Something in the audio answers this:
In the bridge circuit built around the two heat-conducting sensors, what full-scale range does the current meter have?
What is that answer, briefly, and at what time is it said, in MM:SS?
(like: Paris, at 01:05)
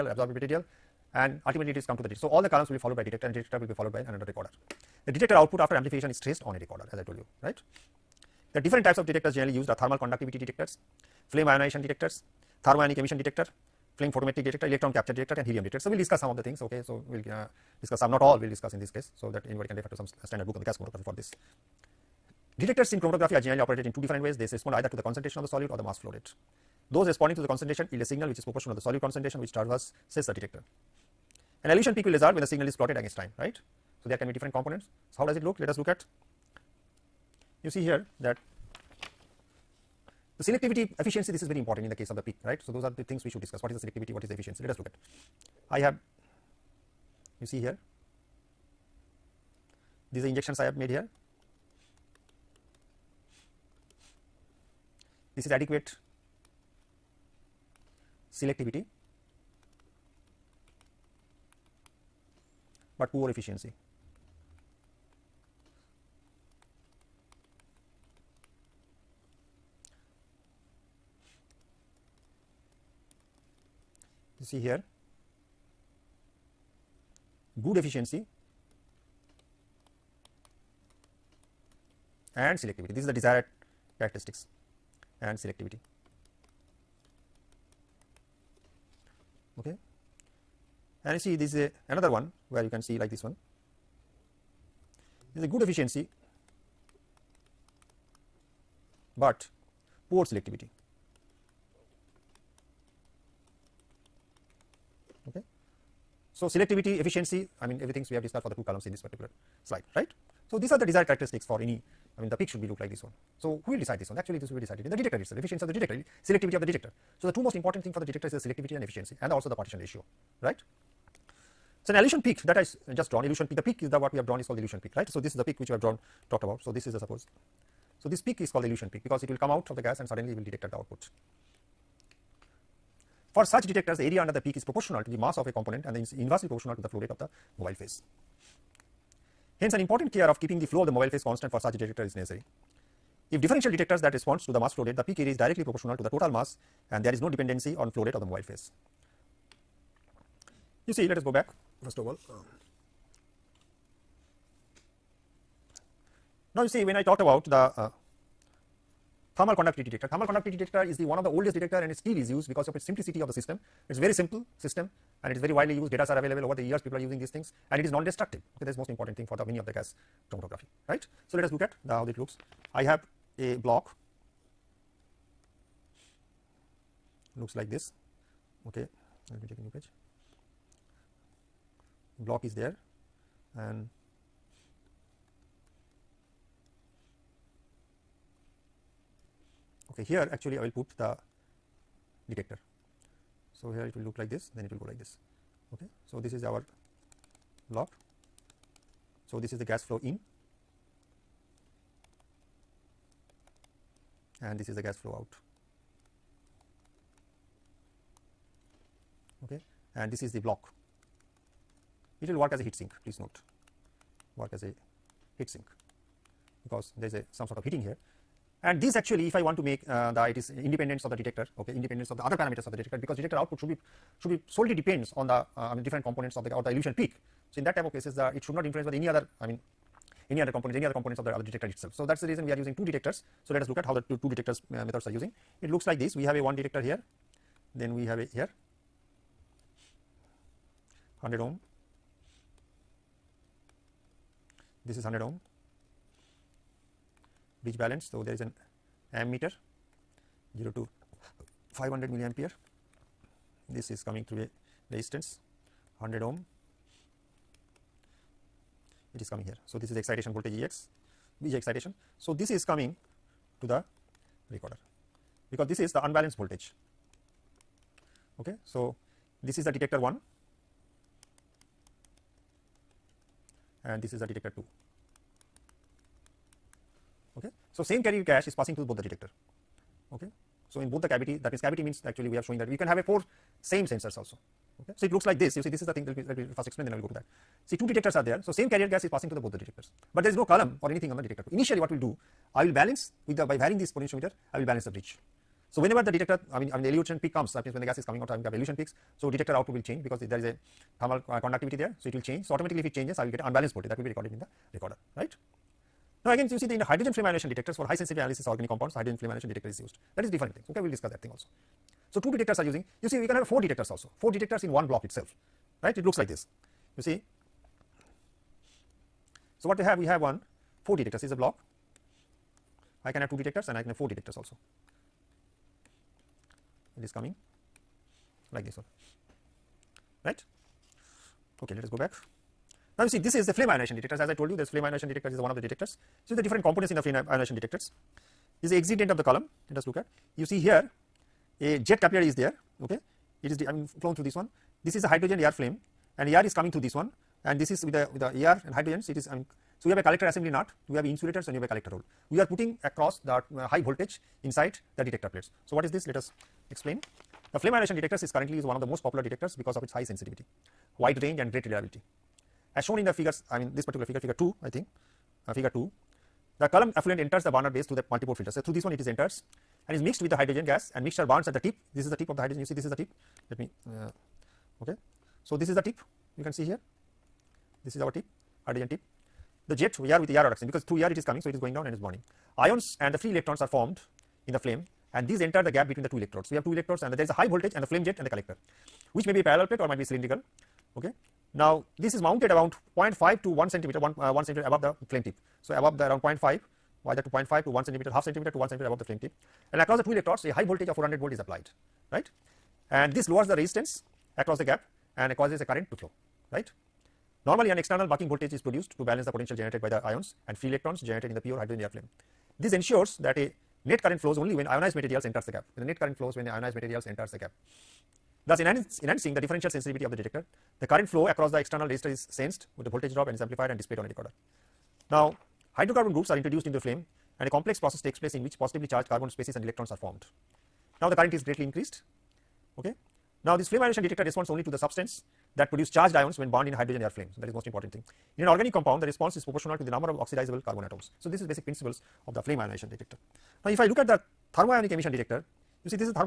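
0 to 500 milliampere, at 04:10.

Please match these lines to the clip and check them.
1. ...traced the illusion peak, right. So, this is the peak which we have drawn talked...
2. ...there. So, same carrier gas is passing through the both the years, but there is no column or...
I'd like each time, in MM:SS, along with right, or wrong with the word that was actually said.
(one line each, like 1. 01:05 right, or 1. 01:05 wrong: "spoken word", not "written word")
1. 02:04 wrong: "called", not "traced"
2. 04:48 wrong: "detectors", not "years".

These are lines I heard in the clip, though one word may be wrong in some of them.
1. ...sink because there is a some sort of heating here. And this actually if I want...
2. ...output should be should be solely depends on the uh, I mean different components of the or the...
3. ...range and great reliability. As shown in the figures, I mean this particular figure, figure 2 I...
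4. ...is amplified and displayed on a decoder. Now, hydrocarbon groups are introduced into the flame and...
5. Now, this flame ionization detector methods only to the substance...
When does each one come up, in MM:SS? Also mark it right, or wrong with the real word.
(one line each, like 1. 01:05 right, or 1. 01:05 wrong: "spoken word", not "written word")
1. 03:35 right
2. 03:43 right
3. 06:01 right
4. 07:03 right
5. 07:13 wrong: "responds", not "methods".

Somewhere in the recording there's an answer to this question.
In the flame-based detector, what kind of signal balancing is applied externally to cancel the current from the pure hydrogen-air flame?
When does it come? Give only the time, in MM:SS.
06:48.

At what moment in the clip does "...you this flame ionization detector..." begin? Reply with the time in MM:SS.
05:34.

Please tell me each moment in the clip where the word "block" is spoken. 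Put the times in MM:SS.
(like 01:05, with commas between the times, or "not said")
02:53, 03:02, 03:30, 05:14, 05:21.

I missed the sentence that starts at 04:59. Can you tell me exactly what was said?
So, detector output will change because the, there is a thermal uh, conductivity there.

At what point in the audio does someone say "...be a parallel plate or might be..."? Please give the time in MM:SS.
06:29.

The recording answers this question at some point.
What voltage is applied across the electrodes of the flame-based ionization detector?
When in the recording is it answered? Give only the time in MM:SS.
06:40.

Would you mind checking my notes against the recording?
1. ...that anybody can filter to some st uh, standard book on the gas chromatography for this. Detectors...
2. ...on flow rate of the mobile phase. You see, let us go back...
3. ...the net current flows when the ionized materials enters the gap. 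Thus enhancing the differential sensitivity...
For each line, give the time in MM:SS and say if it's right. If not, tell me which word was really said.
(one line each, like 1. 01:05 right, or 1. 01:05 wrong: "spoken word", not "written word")
1. 00:19 wrong: "refer", not "filter"
2. 02:27 right
3. 06:55 right.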